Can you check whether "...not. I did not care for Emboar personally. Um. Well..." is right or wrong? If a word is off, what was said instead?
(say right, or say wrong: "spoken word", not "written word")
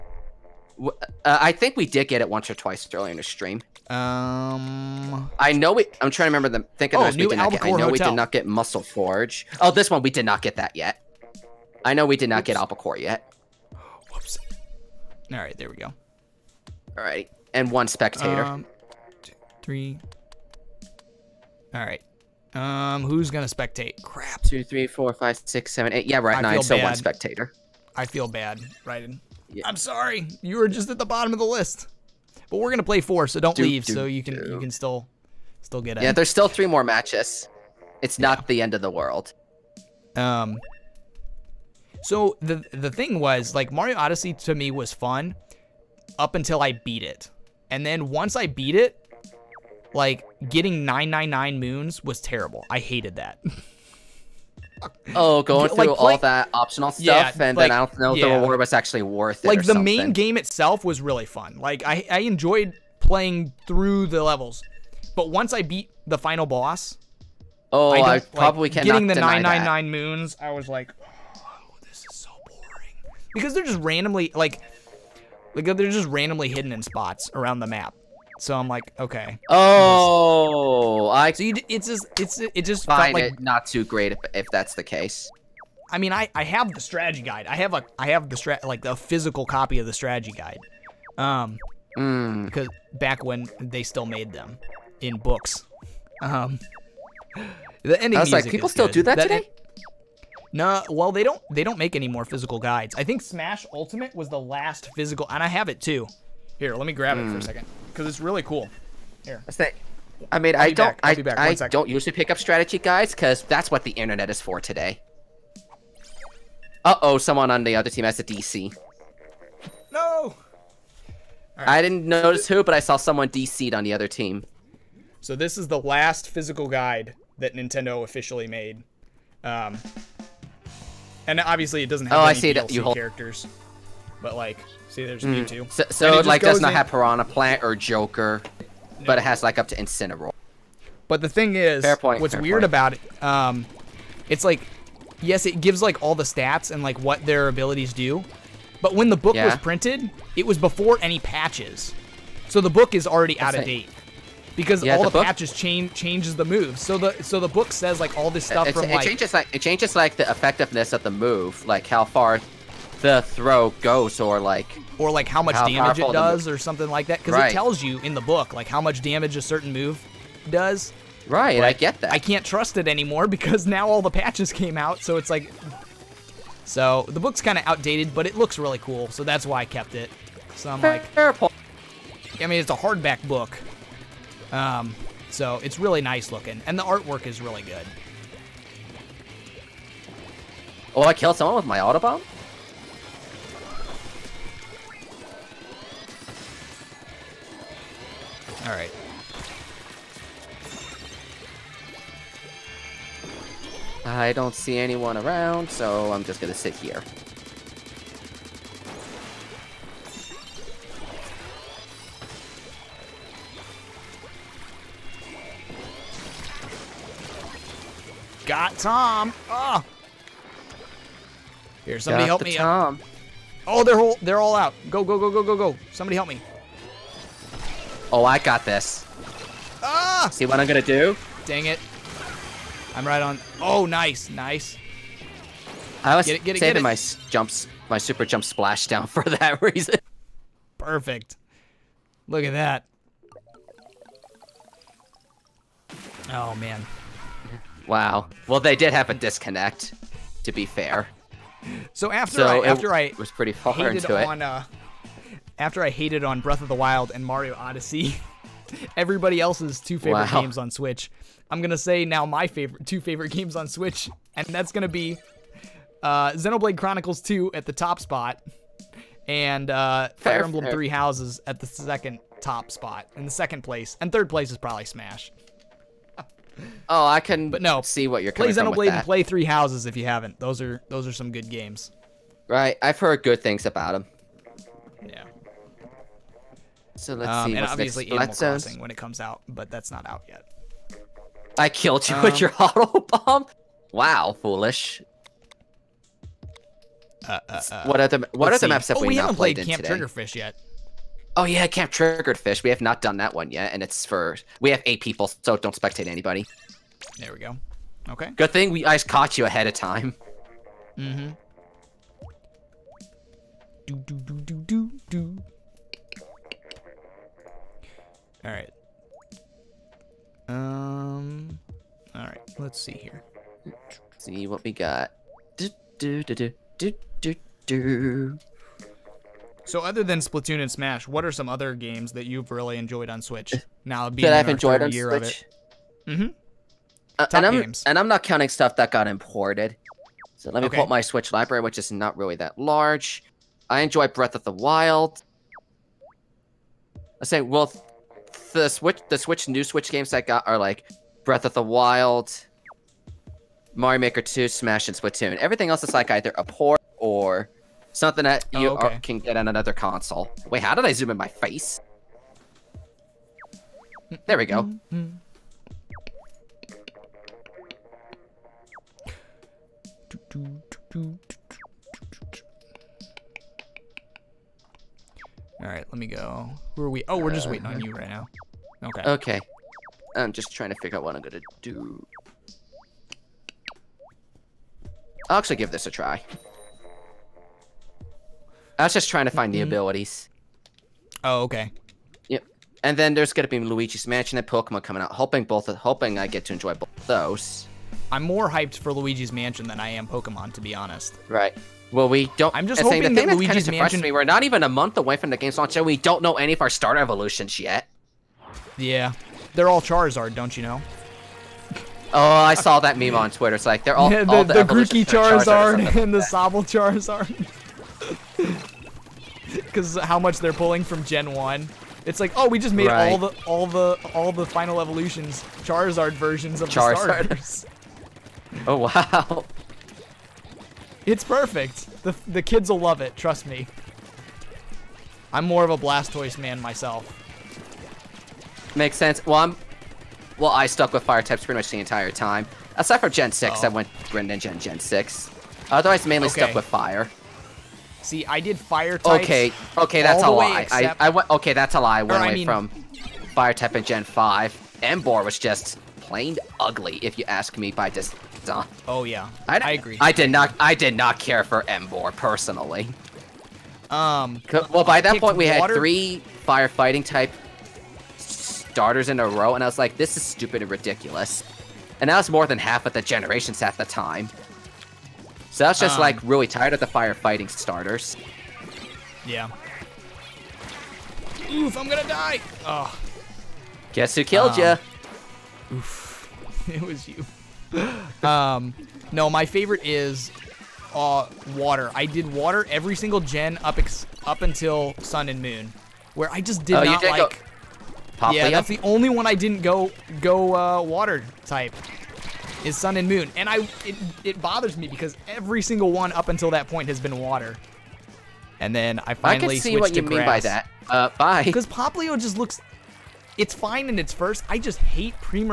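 right.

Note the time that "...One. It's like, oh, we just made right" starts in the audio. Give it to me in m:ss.
7:01.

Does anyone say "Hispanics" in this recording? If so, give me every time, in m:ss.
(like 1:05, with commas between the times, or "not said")
not said.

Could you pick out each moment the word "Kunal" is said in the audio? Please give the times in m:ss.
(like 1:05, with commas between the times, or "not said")
not said.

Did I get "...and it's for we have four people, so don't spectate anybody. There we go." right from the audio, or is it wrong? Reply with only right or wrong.
wrong.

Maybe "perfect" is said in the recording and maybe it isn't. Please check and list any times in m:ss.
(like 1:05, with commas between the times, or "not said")
4:00, 7:11.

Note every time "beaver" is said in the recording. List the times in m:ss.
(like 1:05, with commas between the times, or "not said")
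not said.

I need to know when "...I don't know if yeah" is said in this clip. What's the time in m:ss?
0:57.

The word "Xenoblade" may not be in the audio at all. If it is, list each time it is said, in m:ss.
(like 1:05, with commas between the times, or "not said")
4:26, 4:38.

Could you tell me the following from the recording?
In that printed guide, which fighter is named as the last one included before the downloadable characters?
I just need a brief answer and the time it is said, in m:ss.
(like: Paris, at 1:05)
Incineroar, at 2:19.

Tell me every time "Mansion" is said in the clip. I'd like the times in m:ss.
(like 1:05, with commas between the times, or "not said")
6:34, 6:39, 6:43.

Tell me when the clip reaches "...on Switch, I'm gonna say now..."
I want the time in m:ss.
4:20.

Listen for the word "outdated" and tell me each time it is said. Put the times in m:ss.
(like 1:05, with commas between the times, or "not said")
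2:57.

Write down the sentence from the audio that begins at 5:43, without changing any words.
I enjoy Breath of the Wild.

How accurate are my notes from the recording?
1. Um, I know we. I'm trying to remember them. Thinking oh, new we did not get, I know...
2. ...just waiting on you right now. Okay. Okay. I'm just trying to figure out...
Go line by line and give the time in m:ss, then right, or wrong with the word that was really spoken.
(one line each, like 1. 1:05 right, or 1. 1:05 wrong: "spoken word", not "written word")
1. 0:03 right
2. 6:17 right.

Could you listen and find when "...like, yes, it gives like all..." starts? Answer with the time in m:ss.
2:24.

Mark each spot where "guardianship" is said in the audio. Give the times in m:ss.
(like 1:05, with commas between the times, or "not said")
not said.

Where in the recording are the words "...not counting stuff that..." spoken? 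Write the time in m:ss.
5:38.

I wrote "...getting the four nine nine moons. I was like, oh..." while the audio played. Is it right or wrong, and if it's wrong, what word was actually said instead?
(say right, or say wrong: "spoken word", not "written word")
wrong: "nine", not "four".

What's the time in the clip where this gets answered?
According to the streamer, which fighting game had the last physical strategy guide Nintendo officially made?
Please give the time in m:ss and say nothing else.
1:43.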